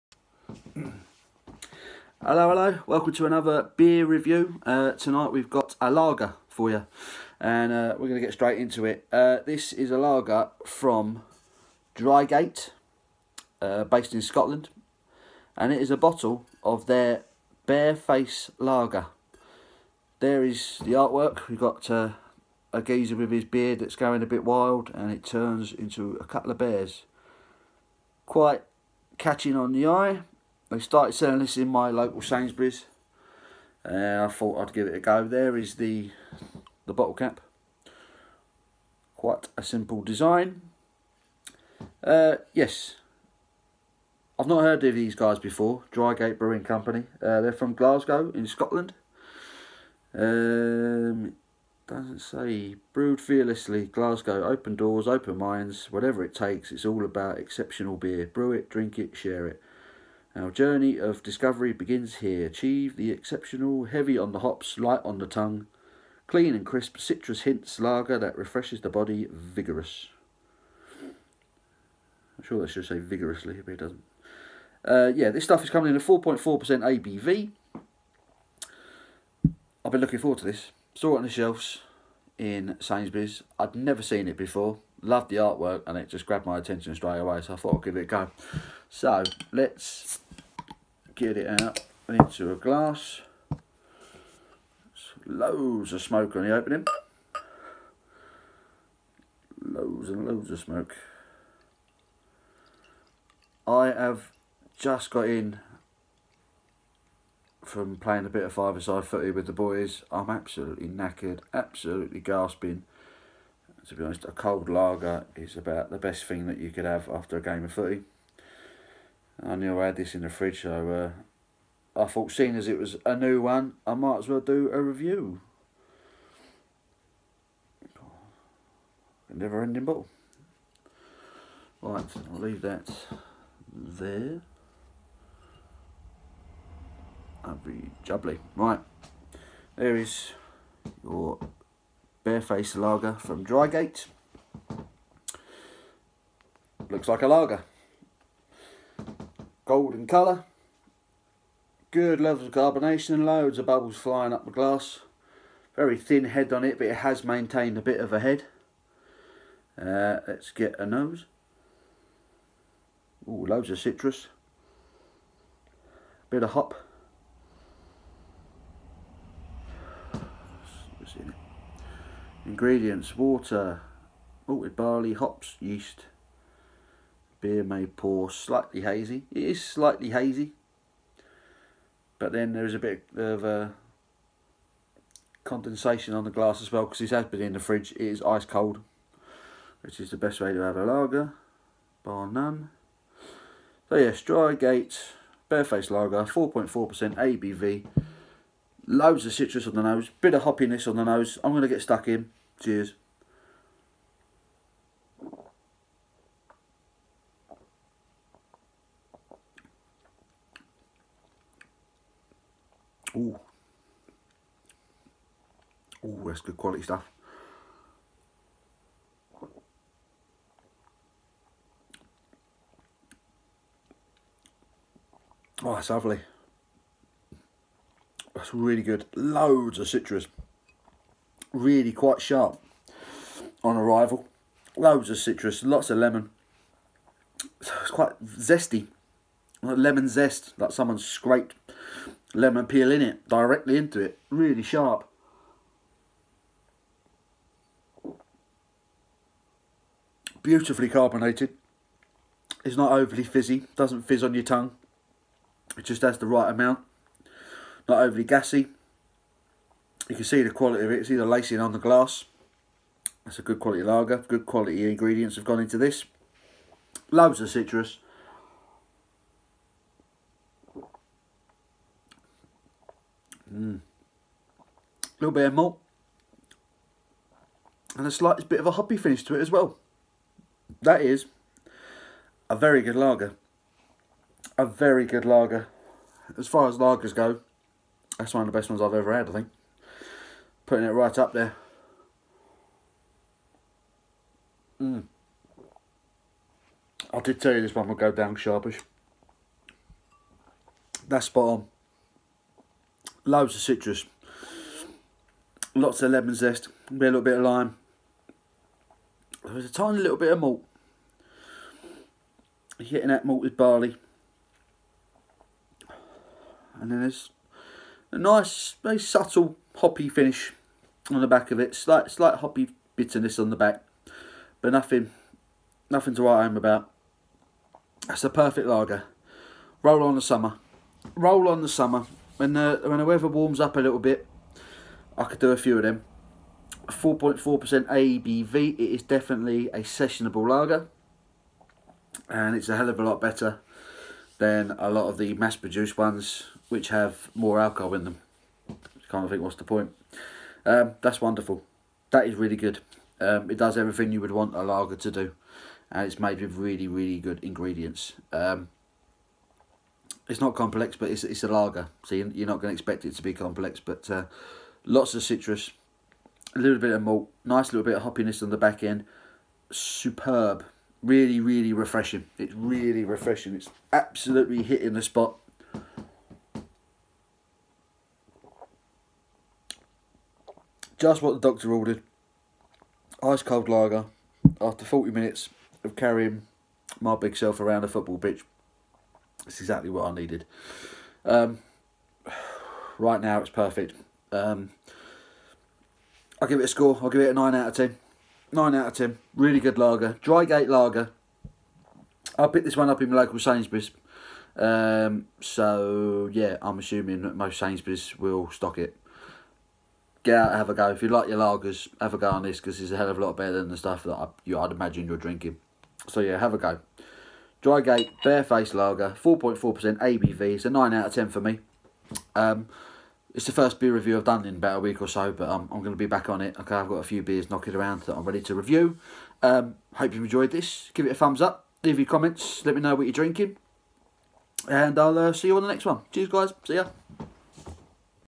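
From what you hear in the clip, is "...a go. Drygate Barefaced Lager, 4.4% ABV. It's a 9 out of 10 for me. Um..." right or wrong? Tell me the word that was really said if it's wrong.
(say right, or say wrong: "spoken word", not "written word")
right.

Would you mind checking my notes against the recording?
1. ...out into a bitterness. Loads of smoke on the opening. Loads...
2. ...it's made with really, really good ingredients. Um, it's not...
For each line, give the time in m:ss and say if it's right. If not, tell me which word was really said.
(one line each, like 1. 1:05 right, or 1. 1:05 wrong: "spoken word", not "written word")
1. 1:31 wrong: "glass", not "bitterness"
2. 5:56 right.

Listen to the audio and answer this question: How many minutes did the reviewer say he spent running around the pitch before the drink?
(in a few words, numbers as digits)
40.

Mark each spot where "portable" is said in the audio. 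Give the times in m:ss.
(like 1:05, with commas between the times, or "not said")
not said.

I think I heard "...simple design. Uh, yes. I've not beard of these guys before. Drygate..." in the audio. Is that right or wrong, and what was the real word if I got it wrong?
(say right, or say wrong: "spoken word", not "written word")
wrong: "heard", not "beard".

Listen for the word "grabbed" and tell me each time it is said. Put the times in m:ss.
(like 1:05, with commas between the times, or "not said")
1:26.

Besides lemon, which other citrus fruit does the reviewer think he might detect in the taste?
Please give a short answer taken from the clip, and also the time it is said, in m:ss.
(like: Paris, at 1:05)
lime, at 5:07.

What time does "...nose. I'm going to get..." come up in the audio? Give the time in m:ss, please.
3:21.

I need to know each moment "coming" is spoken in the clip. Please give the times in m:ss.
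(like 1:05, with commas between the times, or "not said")
1:15.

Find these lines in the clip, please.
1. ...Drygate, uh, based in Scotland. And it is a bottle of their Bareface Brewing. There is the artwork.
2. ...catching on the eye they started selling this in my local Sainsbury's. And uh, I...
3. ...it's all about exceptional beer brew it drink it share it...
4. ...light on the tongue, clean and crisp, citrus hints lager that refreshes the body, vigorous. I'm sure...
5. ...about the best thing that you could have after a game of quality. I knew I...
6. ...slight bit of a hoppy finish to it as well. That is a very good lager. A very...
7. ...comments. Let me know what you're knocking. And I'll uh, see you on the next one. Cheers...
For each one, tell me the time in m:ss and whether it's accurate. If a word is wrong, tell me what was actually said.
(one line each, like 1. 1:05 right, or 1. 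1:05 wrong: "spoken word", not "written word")
1. 0:11 wrong: "Lager", not "Brewing"
2. 0:29 right
3. 0:56 right
4. 1:04 right
5. 1:55 wrong: "footy", not "quality"
6. 4:38 right
7. 7:12 wrong: "drinking", not "knocking".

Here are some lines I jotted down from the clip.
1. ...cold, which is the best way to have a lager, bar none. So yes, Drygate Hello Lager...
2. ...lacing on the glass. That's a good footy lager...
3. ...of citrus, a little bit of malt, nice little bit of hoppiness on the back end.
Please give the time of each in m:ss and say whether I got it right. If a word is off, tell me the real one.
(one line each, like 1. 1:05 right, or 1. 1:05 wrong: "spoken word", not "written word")
1. 3:08 wrong: "Barefaced", not "Hello"
2. 4:21 wrong: "quality", not "footy"
3. 6:05 right.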